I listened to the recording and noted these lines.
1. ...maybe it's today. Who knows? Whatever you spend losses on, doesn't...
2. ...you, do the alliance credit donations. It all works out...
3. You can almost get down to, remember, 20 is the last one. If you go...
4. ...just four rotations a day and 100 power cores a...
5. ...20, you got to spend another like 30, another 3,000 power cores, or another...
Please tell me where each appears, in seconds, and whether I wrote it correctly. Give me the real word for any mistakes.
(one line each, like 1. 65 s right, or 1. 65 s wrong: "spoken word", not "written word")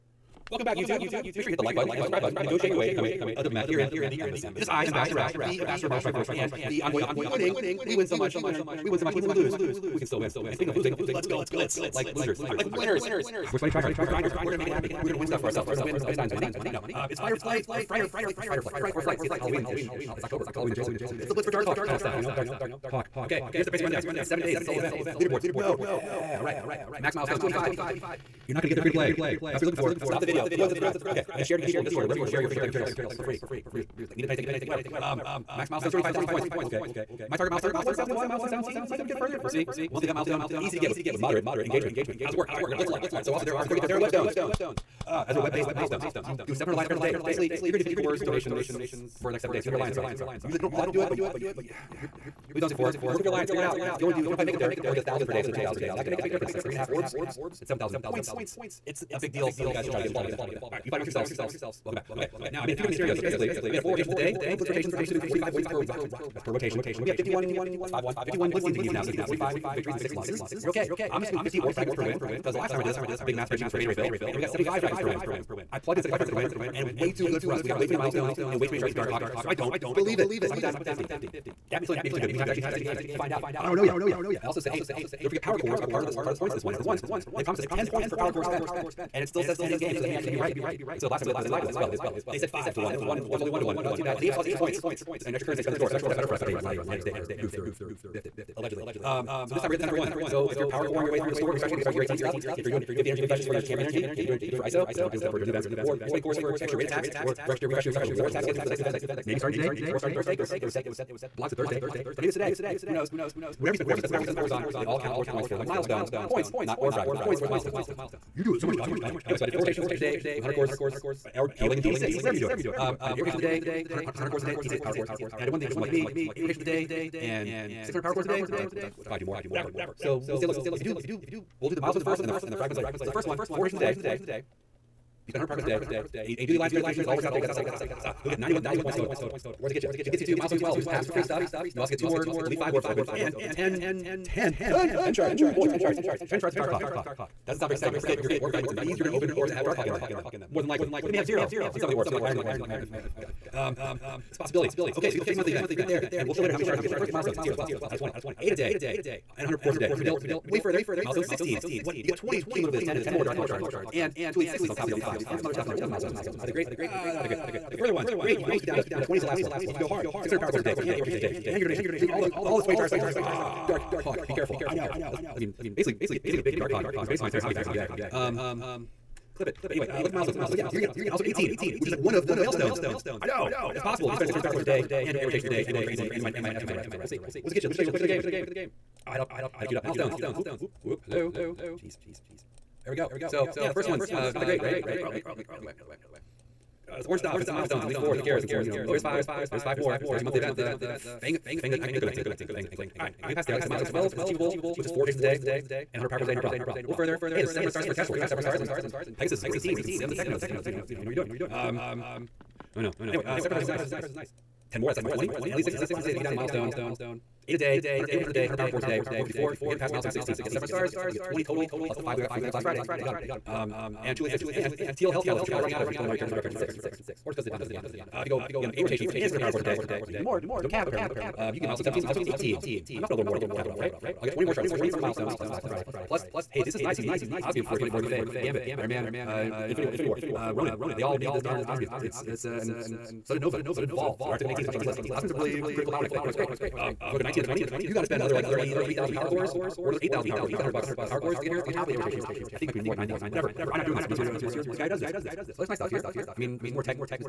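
1. 112 s wrong: "cores", not "losses"
2. 136 s right
3. 168 s right
4. 204 s right
5. 247 s right.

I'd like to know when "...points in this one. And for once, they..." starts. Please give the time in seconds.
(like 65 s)
86 s.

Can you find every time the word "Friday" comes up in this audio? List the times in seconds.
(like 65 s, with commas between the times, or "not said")
222 s, 235 s.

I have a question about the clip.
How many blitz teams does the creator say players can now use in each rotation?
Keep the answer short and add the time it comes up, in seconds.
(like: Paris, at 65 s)
51, at 68 s.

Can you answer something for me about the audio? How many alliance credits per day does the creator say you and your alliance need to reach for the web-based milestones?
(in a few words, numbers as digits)
700.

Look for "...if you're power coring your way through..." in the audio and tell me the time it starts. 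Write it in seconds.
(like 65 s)
100 s.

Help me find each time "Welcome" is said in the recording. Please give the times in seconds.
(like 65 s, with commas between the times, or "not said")
0 s, 61 s.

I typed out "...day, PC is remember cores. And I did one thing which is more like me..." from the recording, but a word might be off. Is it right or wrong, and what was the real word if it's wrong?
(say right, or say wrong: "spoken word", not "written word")
wrong: "power", not "remember".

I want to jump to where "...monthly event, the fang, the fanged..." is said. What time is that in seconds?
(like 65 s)
200 s.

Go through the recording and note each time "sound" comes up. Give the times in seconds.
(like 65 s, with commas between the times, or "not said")
147 s.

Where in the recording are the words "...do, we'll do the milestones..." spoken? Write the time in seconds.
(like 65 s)
130 s.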